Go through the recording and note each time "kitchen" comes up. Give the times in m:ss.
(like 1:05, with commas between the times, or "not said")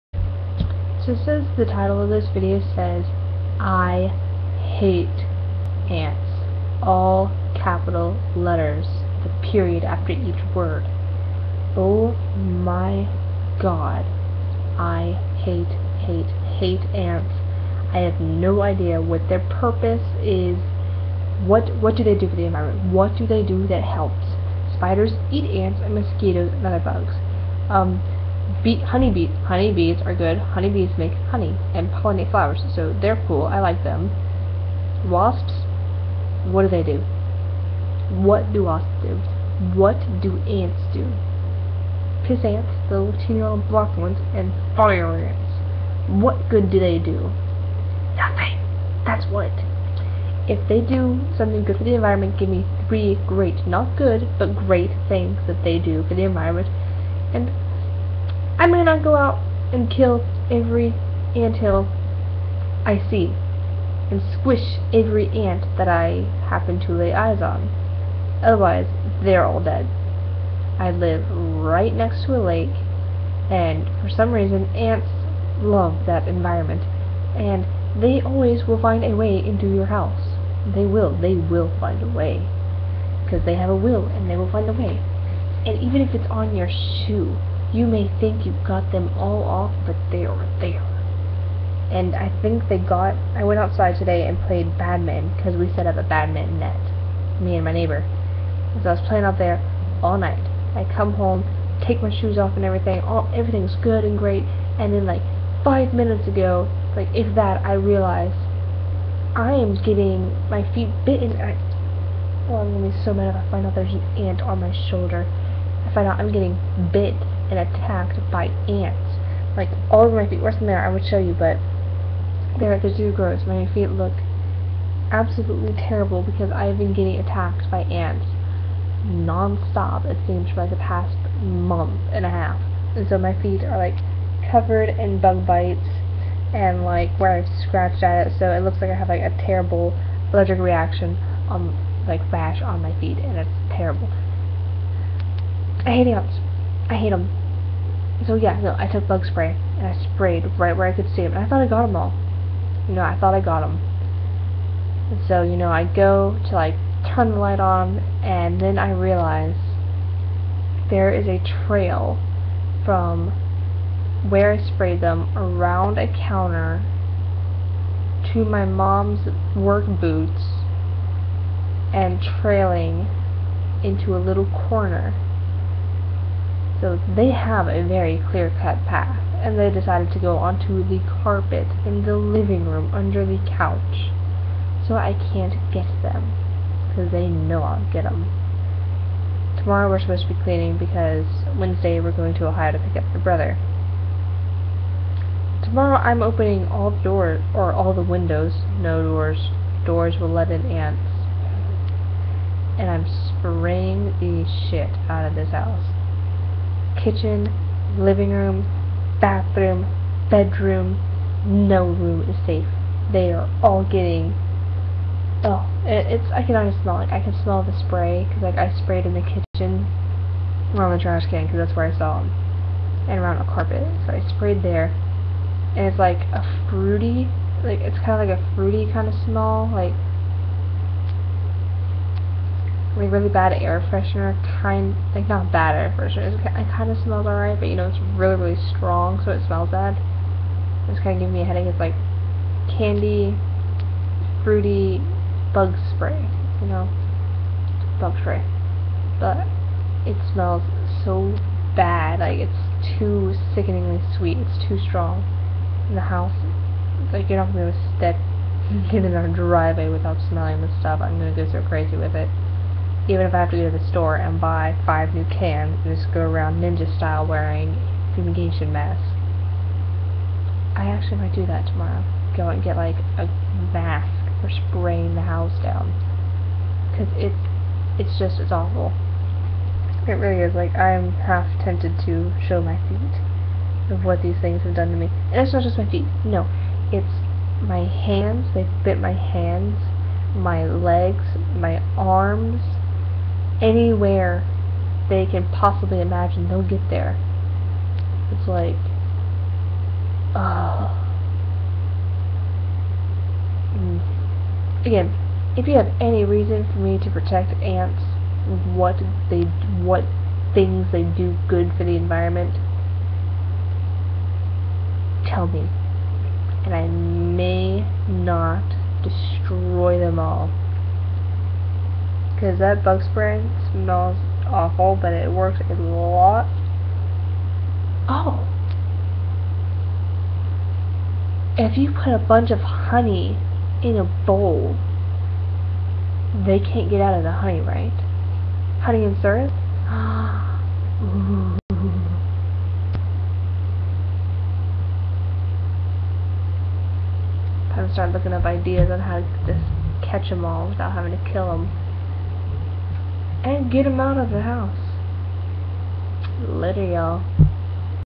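3:27, 3:39.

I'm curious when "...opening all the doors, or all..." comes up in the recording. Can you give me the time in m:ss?
3:16.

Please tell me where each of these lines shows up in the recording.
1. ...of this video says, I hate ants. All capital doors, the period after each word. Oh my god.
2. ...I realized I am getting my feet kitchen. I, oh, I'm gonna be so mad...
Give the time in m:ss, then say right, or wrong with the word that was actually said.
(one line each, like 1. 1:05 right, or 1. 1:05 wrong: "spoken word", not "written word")
1. 0:01 wrong: "letters", not "doors"
2. 1:47 wrong: "bitten", not "kitchen".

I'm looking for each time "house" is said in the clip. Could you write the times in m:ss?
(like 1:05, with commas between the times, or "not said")
1:19, 3:25, 4:16, 4:35, 5:54.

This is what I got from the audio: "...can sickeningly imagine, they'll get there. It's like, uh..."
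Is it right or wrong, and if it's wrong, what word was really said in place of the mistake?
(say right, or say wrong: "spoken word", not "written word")
wrong: "possibly", not "sickeningly".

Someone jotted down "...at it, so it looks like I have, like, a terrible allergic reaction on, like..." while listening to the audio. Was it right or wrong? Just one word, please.
right.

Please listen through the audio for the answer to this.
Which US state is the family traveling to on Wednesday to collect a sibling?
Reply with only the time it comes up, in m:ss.
3:12.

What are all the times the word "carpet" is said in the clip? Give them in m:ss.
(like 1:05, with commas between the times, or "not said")
3:01, 3:43.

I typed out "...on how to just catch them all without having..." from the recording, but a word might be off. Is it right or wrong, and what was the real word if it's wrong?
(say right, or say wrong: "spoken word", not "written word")
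right.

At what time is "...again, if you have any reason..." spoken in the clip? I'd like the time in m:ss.
5:04.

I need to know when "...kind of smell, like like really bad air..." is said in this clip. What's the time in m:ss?
3:48.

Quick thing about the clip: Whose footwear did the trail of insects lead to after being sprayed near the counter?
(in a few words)
Mom's work boots.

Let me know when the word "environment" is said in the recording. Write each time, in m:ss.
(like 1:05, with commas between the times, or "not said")
0:22, 0:51, 0:56, 1:16, 5:11.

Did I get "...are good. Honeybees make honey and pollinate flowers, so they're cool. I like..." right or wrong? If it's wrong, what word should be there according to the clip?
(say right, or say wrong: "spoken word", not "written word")
right.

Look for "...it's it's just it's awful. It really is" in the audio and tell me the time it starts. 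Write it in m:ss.
4:37.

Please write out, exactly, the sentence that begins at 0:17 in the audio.
I have no idea what their purpose is.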